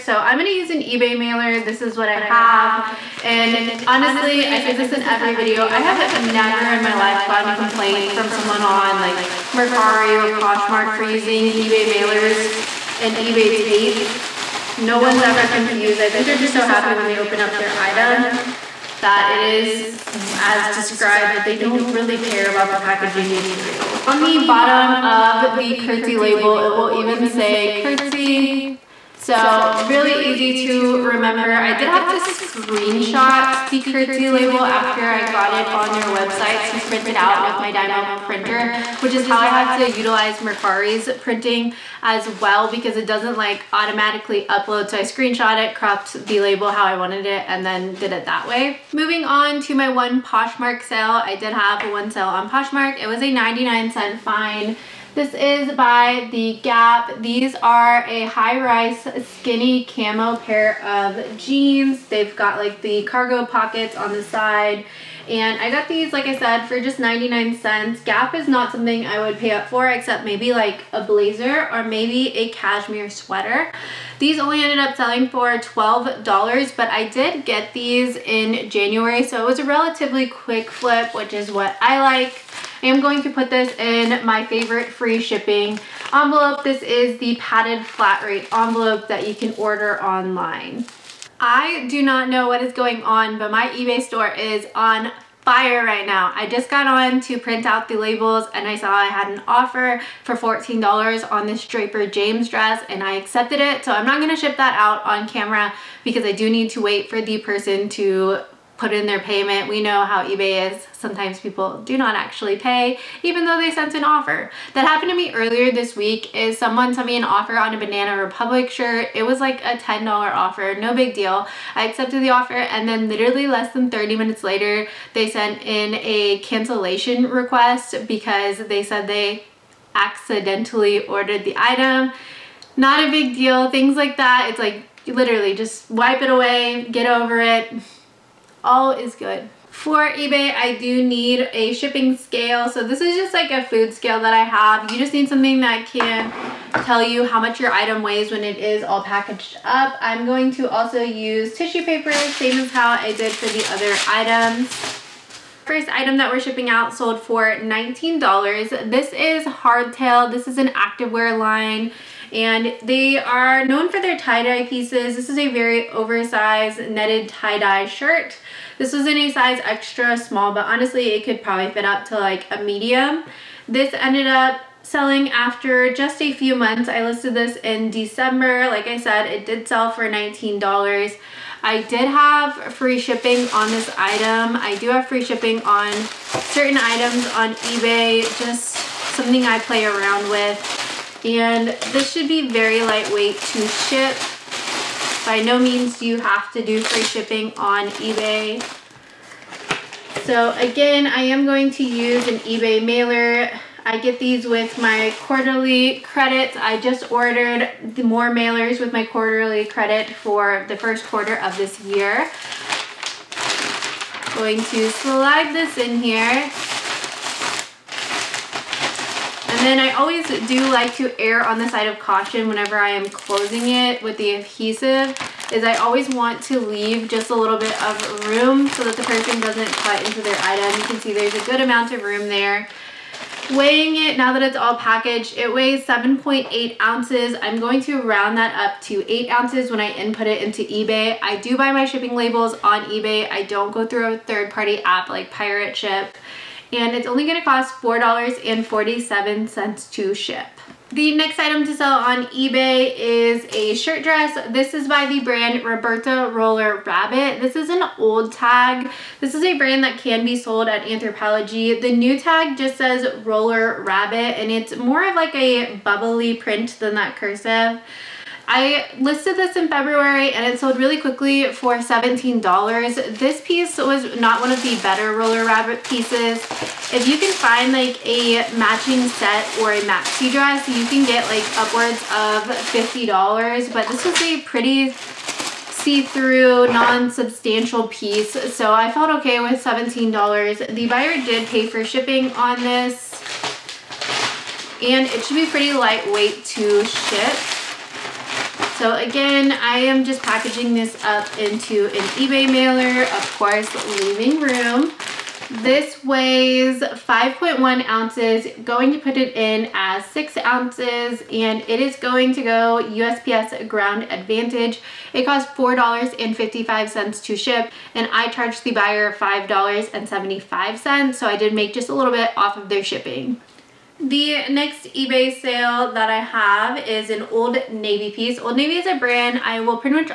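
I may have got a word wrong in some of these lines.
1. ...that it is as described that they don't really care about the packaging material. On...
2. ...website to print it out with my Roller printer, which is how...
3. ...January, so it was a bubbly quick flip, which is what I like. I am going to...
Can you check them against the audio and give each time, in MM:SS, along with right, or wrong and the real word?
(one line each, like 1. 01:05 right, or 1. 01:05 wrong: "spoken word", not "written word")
1. 00:19 right
2. 00:36 wrong: "Dymo", not "Roller"
3. 01:18 wrong: "relatively", not "bubbly".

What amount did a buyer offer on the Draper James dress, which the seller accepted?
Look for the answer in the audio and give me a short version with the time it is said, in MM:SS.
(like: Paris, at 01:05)
$14, at 01:40.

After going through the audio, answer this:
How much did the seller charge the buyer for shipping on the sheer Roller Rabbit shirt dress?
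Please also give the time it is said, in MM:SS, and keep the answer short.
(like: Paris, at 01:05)
$5.75, at 05:19.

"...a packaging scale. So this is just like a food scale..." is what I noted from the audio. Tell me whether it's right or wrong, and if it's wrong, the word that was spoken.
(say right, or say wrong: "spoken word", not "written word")
wrong: "shipping", not "packaging".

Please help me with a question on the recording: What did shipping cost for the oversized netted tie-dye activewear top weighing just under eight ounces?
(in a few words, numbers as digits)
$4.47.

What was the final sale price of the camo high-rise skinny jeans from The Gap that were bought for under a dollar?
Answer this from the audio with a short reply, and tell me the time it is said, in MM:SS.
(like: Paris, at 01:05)
$12, at 01:15.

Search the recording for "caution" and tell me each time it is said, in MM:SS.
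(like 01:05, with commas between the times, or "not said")
03:41.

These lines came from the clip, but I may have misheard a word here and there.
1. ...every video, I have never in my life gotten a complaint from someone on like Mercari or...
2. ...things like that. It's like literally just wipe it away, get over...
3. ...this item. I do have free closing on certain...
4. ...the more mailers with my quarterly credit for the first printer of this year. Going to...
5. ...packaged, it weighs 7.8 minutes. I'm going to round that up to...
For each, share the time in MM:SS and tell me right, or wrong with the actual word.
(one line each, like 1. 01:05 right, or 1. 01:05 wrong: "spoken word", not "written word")
1. 00:05 right
2. 02:13 right
3. 03:03 wrong: "shipping", not "closing"
4. 03:27 wrong: "quarter", not "printer"
5. 03:54 wrong: "ounces", not "minutes".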